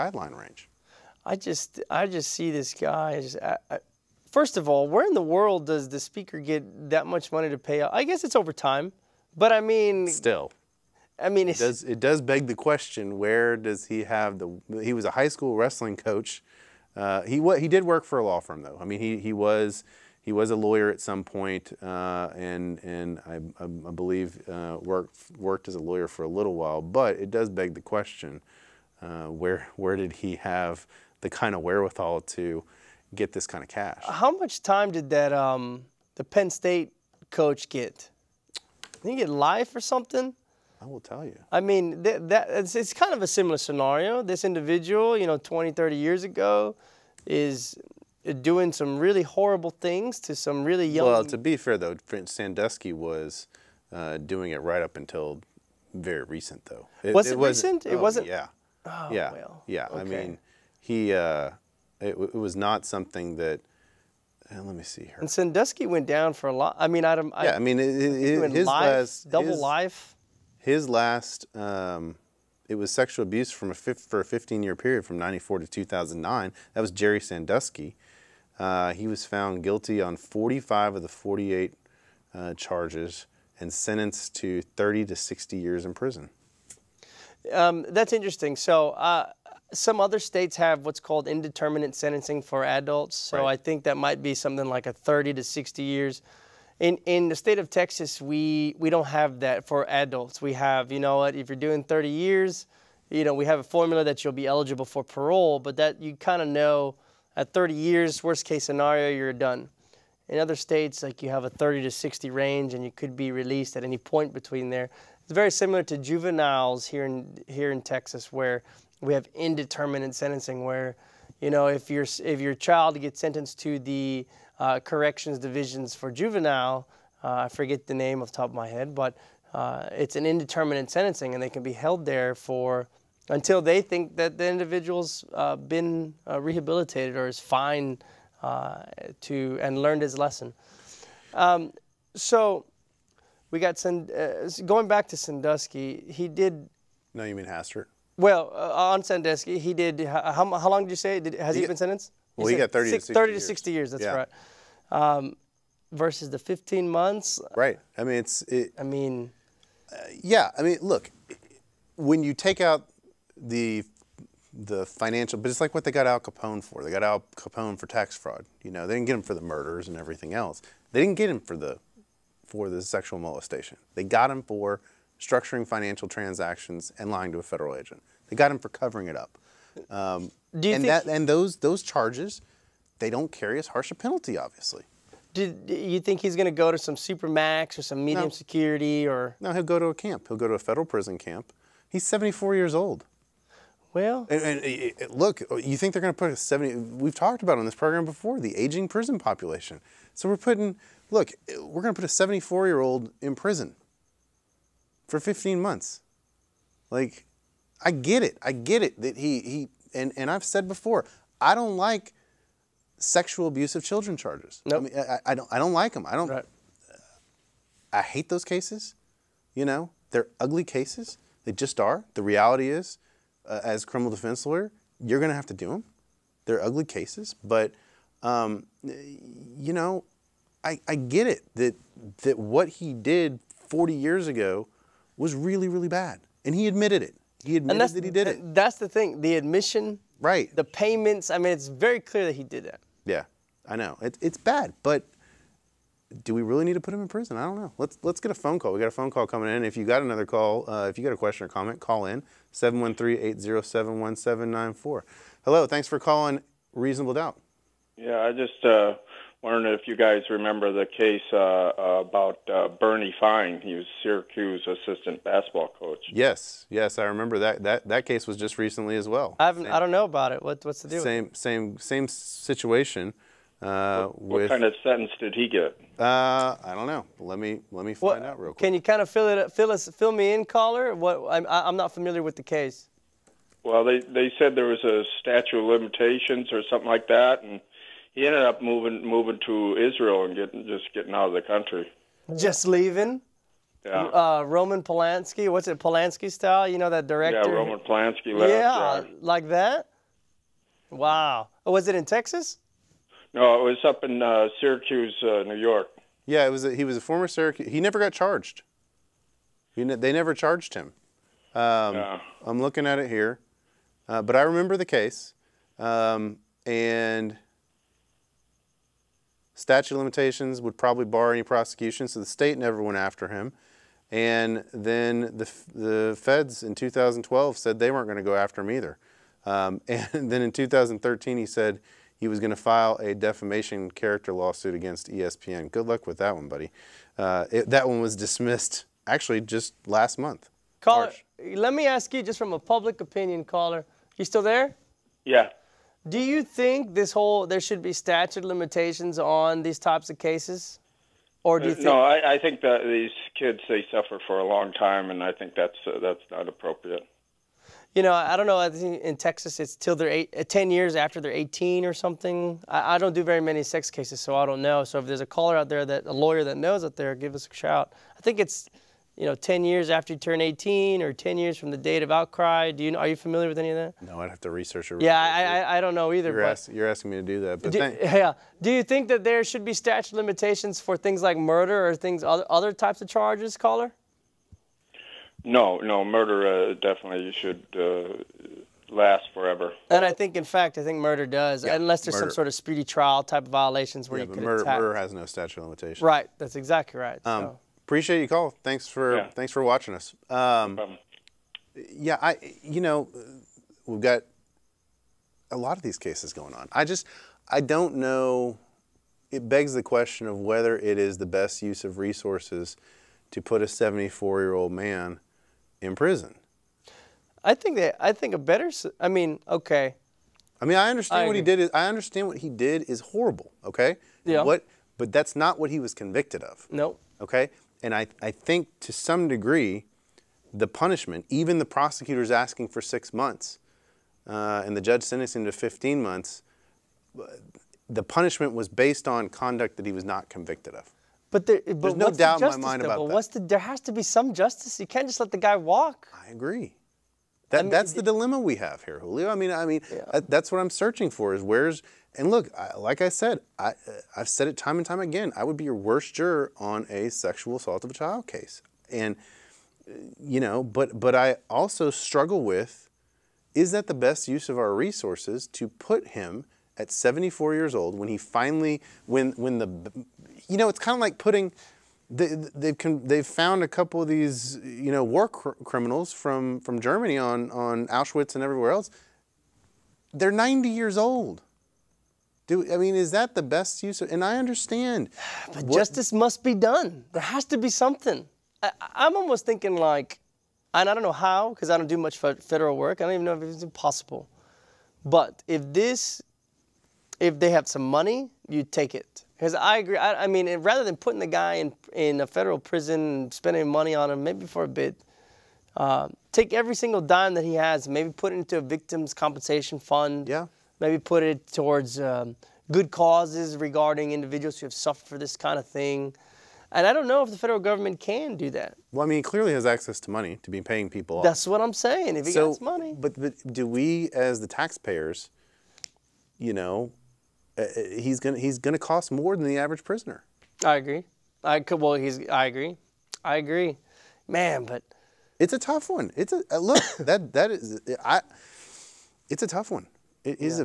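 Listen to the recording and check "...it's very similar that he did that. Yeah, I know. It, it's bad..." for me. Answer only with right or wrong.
wrong.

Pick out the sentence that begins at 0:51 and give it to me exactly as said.
Well, to be fair though, Sandusky was uh, doing it right up until very recent though.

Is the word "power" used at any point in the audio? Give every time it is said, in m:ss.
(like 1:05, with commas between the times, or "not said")
not said.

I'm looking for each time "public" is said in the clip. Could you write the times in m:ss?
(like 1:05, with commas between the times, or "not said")
5:42.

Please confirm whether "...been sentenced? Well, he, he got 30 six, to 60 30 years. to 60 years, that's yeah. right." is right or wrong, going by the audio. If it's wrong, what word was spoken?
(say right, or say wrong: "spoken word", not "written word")
right.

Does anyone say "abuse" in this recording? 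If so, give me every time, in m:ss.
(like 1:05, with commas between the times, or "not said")
1:13, 3:33.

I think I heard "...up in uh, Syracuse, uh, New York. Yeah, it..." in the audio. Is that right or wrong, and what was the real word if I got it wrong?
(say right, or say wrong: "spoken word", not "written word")
right.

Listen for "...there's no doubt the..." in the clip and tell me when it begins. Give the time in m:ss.
7:21.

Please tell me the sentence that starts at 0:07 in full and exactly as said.
I guess it's over time, but I mean, still.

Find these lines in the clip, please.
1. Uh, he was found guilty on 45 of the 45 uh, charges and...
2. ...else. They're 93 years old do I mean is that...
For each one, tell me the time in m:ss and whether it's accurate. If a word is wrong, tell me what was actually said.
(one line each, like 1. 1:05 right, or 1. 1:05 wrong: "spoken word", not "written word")
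1. 1:18 wrong: "48", not "45"
2. 7:58 wrong: "90", not "93".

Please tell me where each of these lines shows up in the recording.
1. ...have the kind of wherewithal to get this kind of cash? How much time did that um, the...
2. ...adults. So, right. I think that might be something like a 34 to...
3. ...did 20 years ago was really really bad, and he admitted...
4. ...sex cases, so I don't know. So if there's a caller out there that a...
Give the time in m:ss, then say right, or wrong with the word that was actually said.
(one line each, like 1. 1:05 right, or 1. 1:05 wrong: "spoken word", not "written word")
1. 0:30 right
2. 1:32 wrong: "30", not "34"
3. 3:52 wrong: "40", not "20"
4. 6:03 right.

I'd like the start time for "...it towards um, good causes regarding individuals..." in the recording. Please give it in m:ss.
8:31.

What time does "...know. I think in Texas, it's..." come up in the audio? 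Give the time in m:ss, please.
5:58.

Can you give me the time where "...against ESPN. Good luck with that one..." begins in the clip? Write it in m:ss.
5:34.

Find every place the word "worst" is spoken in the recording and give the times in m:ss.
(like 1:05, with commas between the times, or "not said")
1:48, 7:35.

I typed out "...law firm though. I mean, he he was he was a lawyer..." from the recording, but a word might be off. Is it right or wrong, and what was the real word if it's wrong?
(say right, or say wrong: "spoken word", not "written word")
right.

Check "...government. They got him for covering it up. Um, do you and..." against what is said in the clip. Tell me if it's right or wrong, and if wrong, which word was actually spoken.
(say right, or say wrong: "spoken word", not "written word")
wrong: "agent", not "government".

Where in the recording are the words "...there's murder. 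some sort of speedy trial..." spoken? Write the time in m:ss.
6:32.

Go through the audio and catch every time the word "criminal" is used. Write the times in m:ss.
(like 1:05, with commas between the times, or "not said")
3:43, 7:55.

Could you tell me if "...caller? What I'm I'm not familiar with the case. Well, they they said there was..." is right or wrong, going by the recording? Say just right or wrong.
right.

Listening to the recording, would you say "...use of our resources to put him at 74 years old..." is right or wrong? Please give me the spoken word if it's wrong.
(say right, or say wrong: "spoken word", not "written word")
right.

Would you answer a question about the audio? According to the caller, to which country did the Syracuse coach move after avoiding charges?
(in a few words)
Israel.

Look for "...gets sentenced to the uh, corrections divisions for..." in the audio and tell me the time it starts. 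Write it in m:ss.
2:03.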